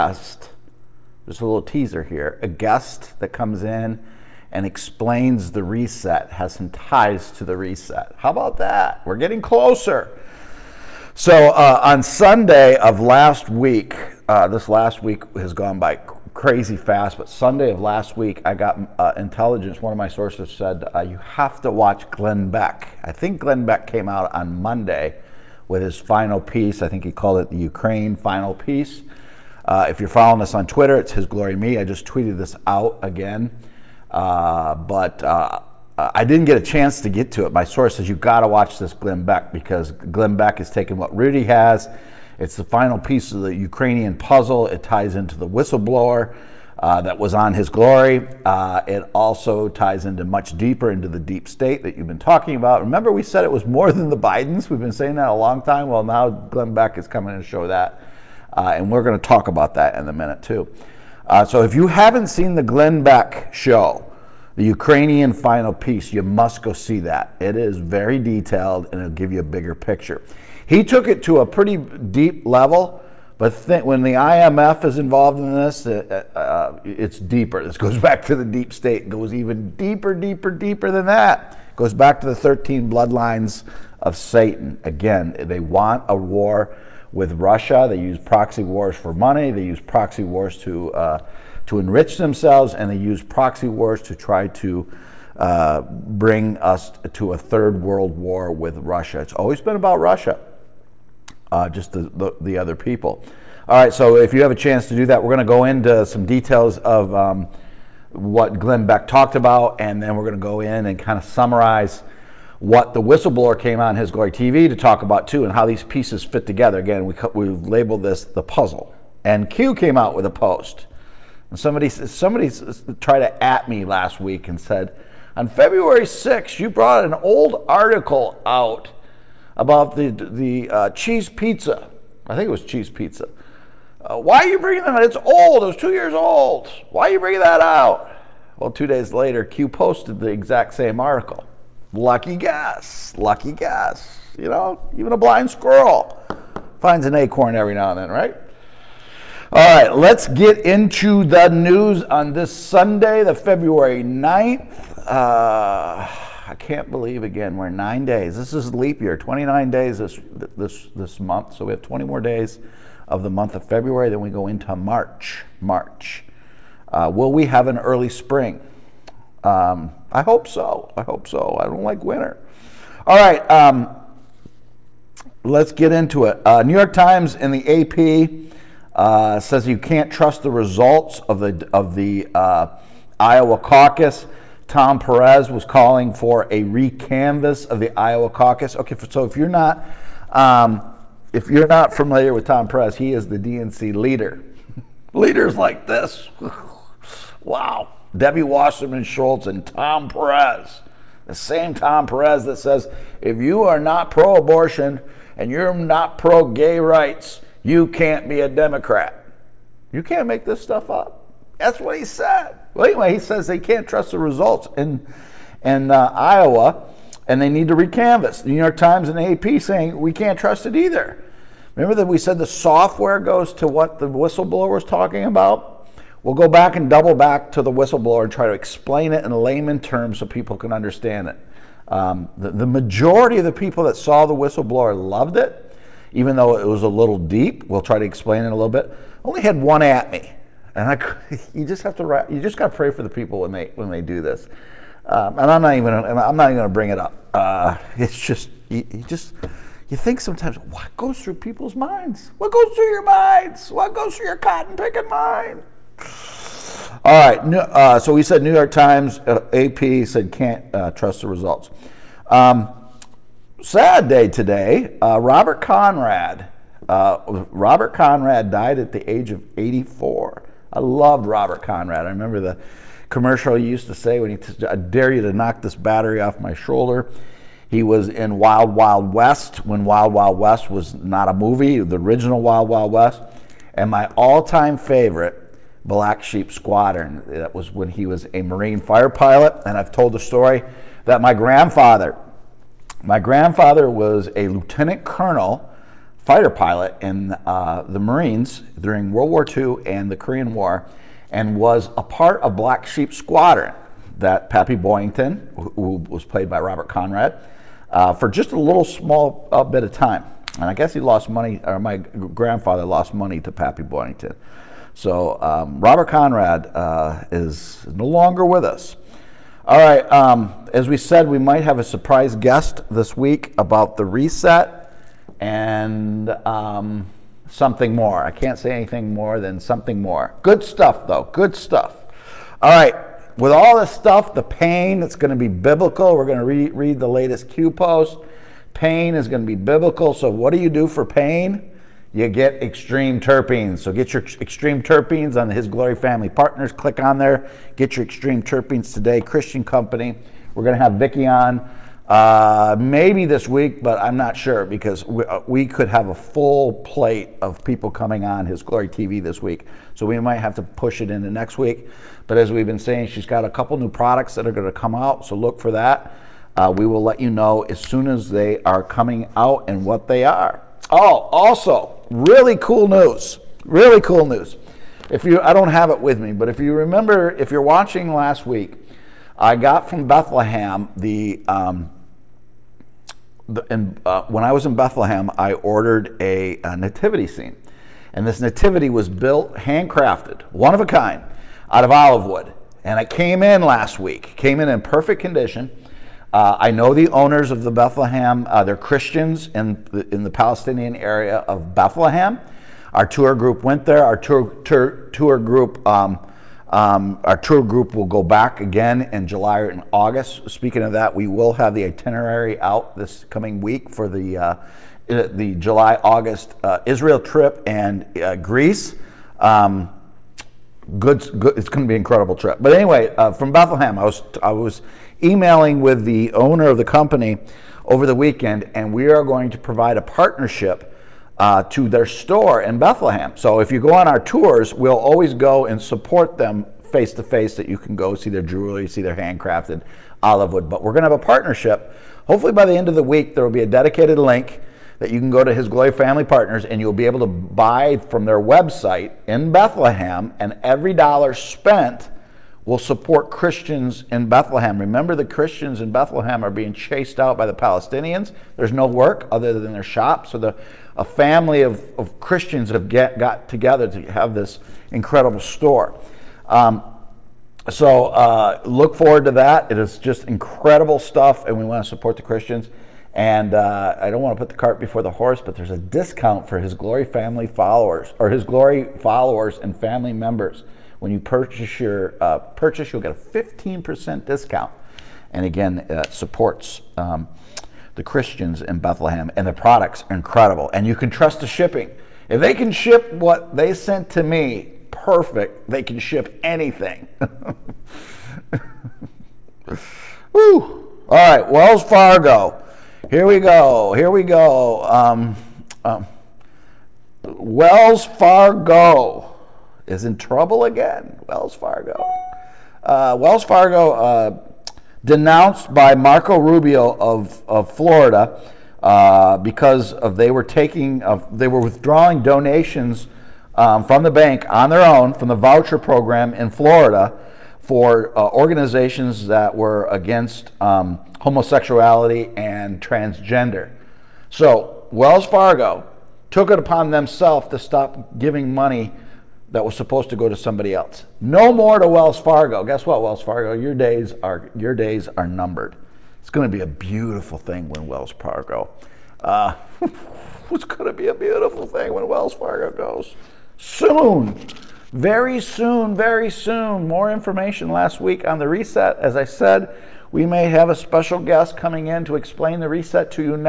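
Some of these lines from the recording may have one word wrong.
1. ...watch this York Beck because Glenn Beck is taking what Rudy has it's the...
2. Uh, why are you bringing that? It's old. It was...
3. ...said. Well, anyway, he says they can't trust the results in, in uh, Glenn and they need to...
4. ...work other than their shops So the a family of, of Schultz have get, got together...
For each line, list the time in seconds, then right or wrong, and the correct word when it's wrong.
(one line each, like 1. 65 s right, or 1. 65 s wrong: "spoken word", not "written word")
1. 38 s wrong: "Glenn", not "York"
2. 134 s right
3. 212 s wrong: "Iowa", not "Glenn"
4. 458 s wrong: "Christians", not "Schultz".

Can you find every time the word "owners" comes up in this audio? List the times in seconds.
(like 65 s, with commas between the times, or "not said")
397 s, 426 s.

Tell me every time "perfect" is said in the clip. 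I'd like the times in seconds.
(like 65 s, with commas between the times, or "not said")
394 s, 494 s.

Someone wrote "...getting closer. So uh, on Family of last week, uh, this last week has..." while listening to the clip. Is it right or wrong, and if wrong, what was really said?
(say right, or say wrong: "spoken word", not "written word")
wrong: "Sunday", not "Family".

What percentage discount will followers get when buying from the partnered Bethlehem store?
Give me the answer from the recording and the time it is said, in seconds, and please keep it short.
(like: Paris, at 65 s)
15%, at 483 s.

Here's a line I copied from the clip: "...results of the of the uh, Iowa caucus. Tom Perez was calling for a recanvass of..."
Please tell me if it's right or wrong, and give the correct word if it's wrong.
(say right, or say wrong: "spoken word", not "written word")
right.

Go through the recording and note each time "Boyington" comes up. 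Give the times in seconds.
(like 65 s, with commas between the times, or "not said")
304 s, 313 s.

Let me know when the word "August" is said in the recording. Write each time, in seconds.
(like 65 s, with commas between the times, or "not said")
409 s, 416 s.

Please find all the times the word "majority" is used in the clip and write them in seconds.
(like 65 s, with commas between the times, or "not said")
232 s.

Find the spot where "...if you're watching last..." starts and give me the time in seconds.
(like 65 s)
377 s.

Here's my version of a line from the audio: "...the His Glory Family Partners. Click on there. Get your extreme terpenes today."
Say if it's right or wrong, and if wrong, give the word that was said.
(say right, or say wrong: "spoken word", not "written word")
right.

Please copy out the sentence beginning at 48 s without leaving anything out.
Uh, it also ties into much deeper into the deep state that you've been talking about.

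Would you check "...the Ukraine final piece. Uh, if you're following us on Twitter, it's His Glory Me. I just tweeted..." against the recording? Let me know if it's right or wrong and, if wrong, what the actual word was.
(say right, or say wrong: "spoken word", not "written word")
right.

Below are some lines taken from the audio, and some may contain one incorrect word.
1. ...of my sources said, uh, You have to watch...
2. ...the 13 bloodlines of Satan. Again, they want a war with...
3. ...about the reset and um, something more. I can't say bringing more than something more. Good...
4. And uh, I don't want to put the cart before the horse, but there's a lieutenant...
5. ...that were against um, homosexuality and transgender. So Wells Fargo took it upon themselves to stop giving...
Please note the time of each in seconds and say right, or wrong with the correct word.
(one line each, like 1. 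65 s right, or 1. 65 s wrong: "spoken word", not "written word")
1. 19 s right
2. 82 s right
3. 323 s wrong: "anything", not "bringing"
4. 473 s wrong: "discount", not "lieutenant"
5. 529 s right.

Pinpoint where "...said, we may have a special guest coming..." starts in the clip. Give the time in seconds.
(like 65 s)
559 s.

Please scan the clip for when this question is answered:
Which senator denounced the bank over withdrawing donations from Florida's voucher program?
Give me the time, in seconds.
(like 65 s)
515 s.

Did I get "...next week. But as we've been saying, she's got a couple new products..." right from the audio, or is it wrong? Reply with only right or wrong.
right.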